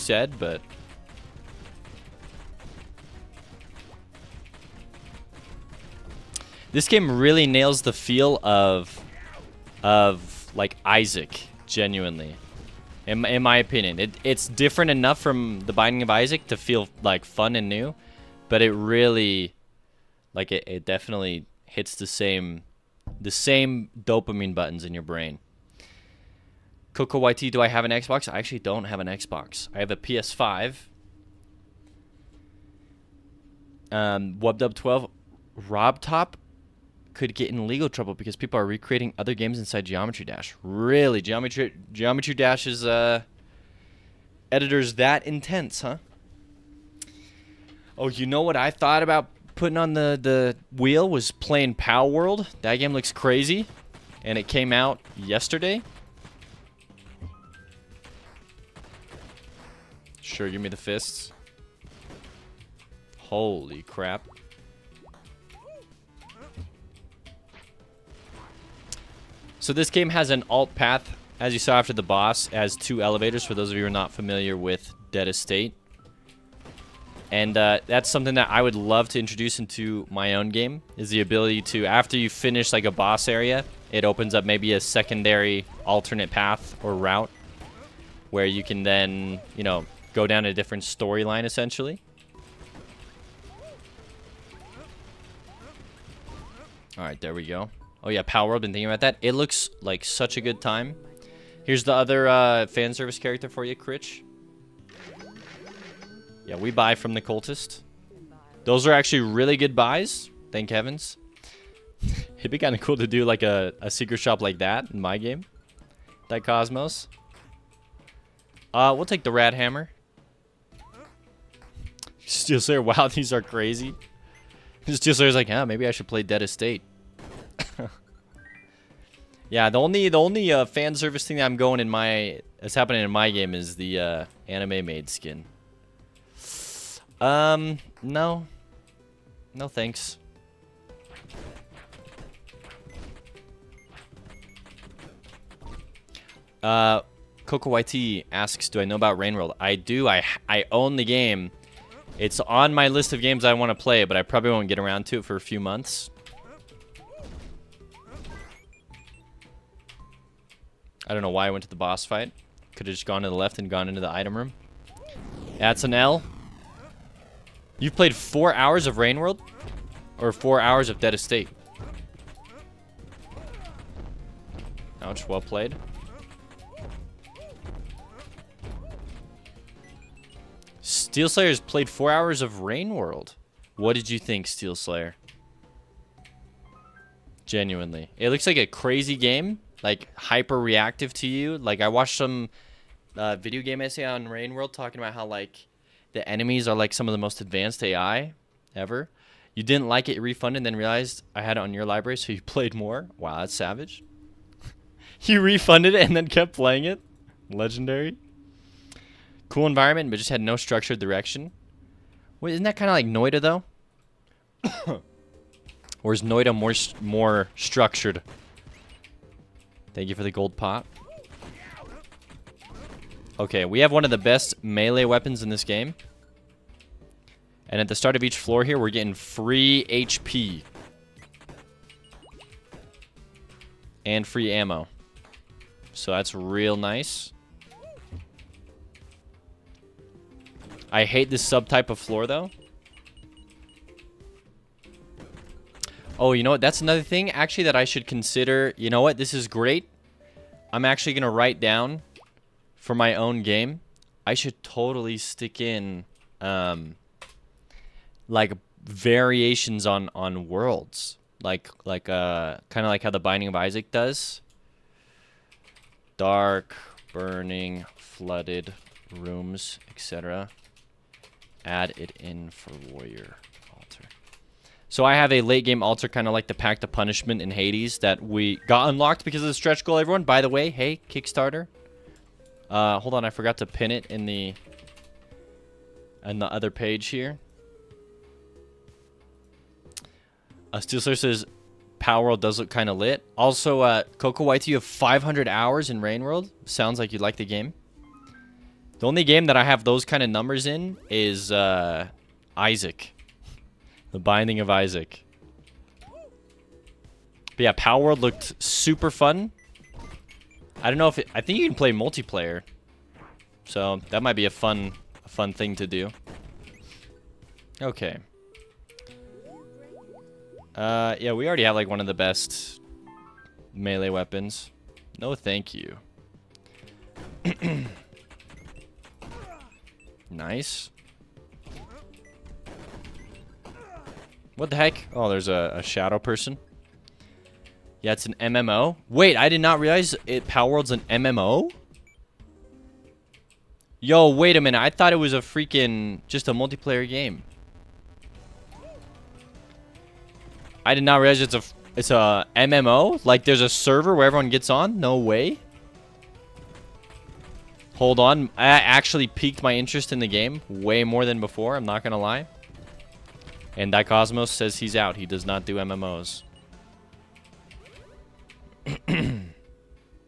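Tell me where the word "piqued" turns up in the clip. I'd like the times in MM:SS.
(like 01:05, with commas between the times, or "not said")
05:59.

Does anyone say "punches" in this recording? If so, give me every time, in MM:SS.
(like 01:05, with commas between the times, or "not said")
not said.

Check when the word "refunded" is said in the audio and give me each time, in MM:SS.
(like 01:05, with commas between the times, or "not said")
03:20, 03:25.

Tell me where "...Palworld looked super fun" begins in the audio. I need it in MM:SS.
05:07.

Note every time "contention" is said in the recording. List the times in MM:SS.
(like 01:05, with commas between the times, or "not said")
not said.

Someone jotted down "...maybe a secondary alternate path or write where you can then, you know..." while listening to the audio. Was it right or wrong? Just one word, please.
wrong.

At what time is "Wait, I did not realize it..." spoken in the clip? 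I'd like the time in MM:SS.
05:39.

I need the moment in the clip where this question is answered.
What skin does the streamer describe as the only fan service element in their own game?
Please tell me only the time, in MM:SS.
02:14.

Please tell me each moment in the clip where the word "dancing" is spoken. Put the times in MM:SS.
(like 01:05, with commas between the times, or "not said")
not said.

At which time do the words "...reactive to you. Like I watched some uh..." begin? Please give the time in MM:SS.
03:10.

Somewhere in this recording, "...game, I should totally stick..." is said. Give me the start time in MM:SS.
04:13.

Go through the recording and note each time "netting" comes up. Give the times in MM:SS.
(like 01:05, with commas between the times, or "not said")
not said.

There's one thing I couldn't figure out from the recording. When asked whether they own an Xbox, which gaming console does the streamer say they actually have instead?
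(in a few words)
PS5.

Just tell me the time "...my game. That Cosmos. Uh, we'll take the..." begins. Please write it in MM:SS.
01:54.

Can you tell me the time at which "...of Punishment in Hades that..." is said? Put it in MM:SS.
04:36.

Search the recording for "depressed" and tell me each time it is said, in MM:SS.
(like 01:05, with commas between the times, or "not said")
not said.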